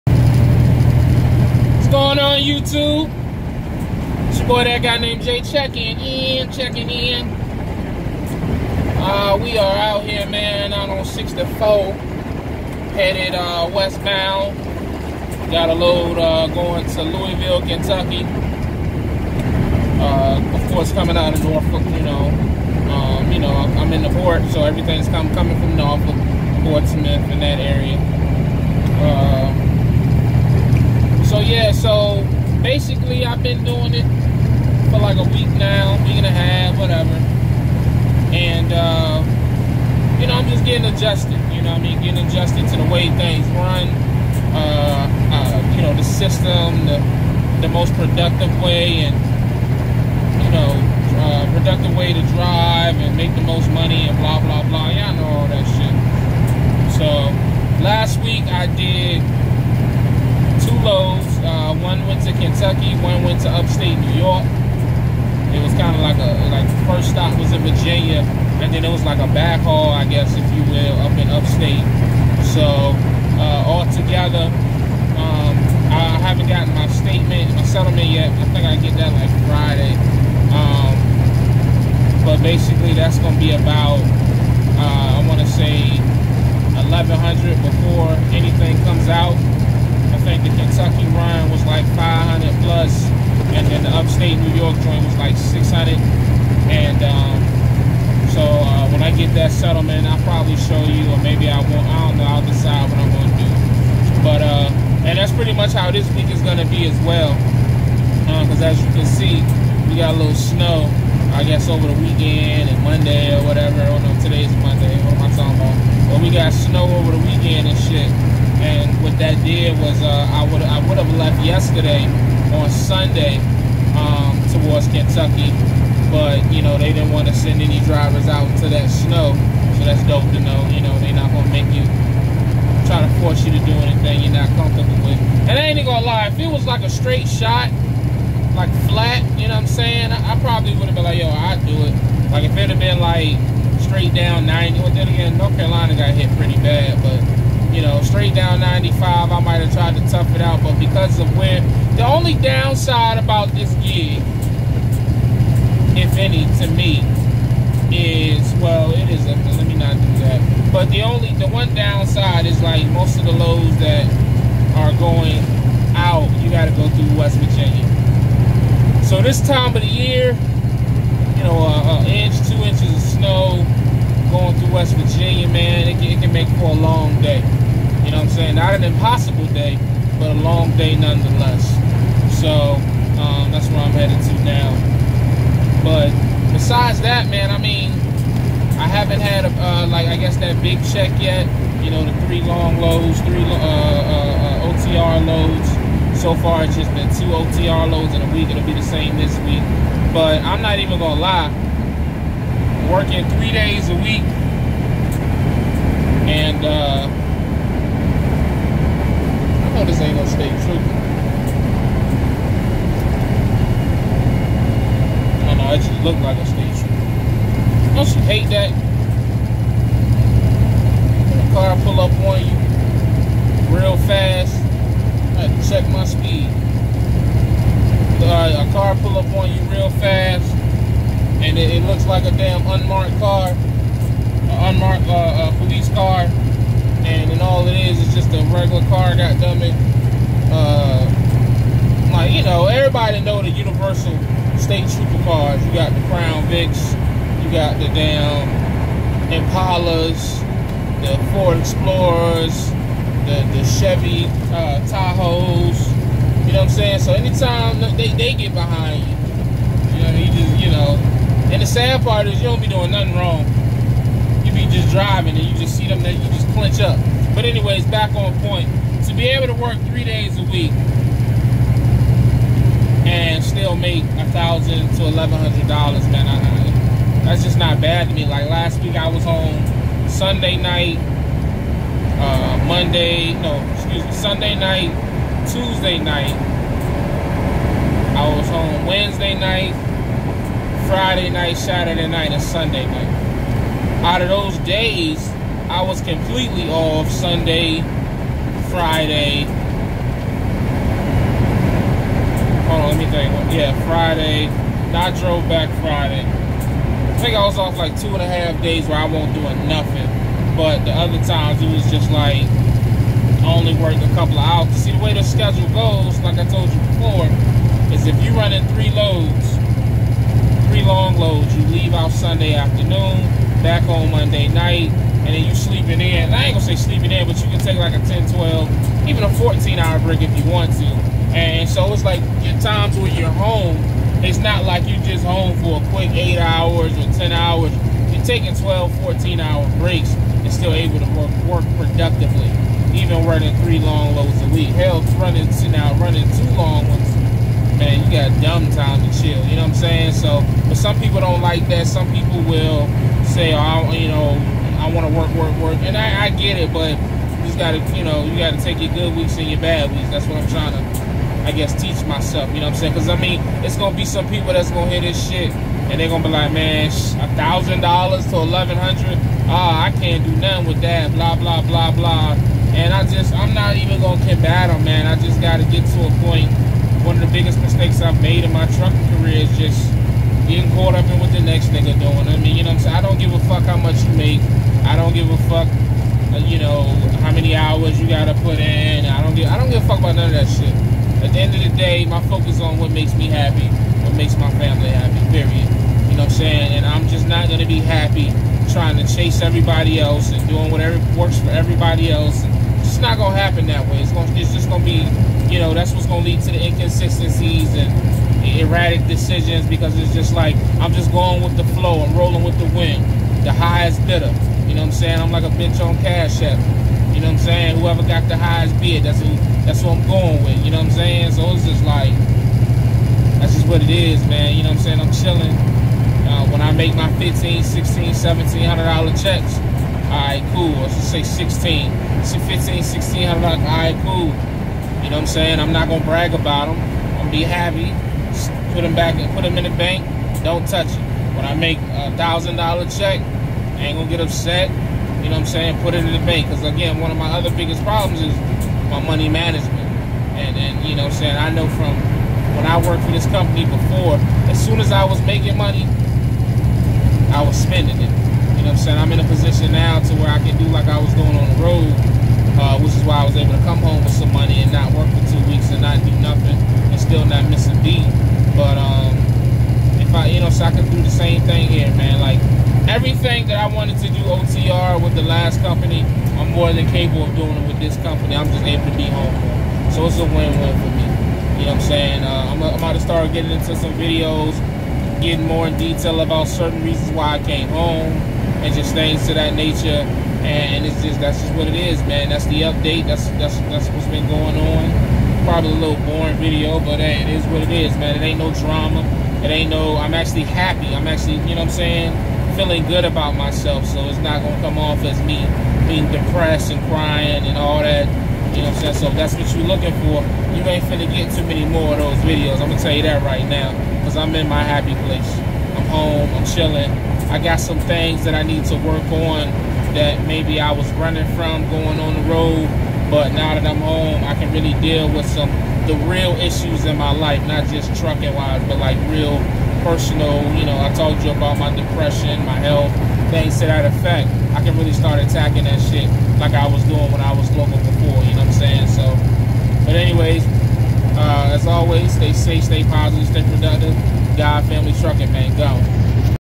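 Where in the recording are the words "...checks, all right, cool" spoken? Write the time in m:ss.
7:09.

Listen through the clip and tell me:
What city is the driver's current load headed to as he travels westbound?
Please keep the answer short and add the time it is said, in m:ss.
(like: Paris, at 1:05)
Louisville, Kentucky, at 0:17.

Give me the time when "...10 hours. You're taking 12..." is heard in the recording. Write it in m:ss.
5:37.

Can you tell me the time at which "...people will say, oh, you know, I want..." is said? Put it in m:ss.
5:52.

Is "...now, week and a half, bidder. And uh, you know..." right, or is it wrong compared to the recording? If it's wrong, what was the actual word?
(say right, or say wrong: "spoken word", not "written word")
wrong: "whatever", not "bidder".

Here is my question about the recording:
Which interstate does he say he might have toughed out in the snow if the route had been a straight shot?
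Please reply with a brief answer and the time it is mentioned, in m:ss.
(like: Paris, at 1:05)
95, at 2:28.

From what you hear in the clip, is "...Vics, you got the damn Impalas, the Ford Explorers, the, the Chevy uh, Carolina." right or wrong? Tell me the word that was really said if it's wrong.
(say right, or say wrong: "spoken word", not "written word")
wrong: "Tahoes", not "Carolina".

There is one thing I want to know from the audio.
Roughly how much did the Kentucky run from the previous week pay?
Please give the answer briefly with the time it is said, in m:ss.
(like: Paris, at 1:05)
500 plus, at 1:31.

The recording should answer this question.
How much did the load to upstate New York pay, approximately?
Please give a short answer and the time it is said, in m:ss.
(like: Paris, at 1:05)
600, at 1:35.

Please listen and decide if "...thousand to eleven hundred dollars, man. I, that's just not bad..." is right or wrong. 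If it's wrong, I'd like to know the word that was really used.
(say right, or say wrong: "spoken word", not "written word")
right.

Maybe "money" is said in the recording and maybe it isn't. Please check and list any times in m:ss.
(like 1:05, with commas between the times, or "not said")
0:53, 7:28, 7:35, 7:44.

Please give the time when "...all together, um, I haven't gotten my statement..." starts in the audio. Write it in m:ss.
1:13.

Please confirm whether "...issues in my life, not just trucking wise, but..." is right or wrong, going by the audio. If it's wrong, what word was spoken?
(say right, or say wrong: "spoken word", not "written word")
right.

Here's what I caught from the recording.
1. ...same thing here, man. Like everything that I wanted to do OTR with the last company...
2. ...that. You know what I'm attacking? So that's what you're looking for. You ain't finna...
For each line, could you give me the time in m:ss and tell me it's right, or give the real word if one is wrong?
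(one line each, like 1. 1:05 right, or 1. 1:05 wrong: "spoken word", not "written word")
1. 7:51 right
2. 8:27 wrong: "saying", not "attacking".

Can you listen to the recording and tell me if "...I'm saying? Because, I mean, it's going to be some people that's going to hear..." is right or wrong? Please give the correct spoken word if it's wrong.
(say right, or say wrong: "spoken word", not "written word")
right.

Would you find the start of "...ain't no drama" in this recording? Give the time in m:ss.
8:18.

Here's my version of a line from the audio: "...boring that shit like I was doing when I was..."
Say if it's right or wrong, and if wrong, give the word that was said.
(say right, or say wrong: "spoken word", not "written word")
wrong: "attacking", not "boring".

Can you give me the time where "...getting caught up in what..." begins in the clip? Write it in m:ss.
6:20.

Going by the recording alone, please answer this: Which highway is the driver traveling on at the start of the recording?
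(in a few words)
64.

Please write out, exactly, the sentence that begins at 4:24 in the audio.
You be just driving and you just see them that you just clinch up.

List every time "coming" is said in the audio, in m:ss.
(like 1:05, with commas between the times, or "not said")
0:20, 0:25.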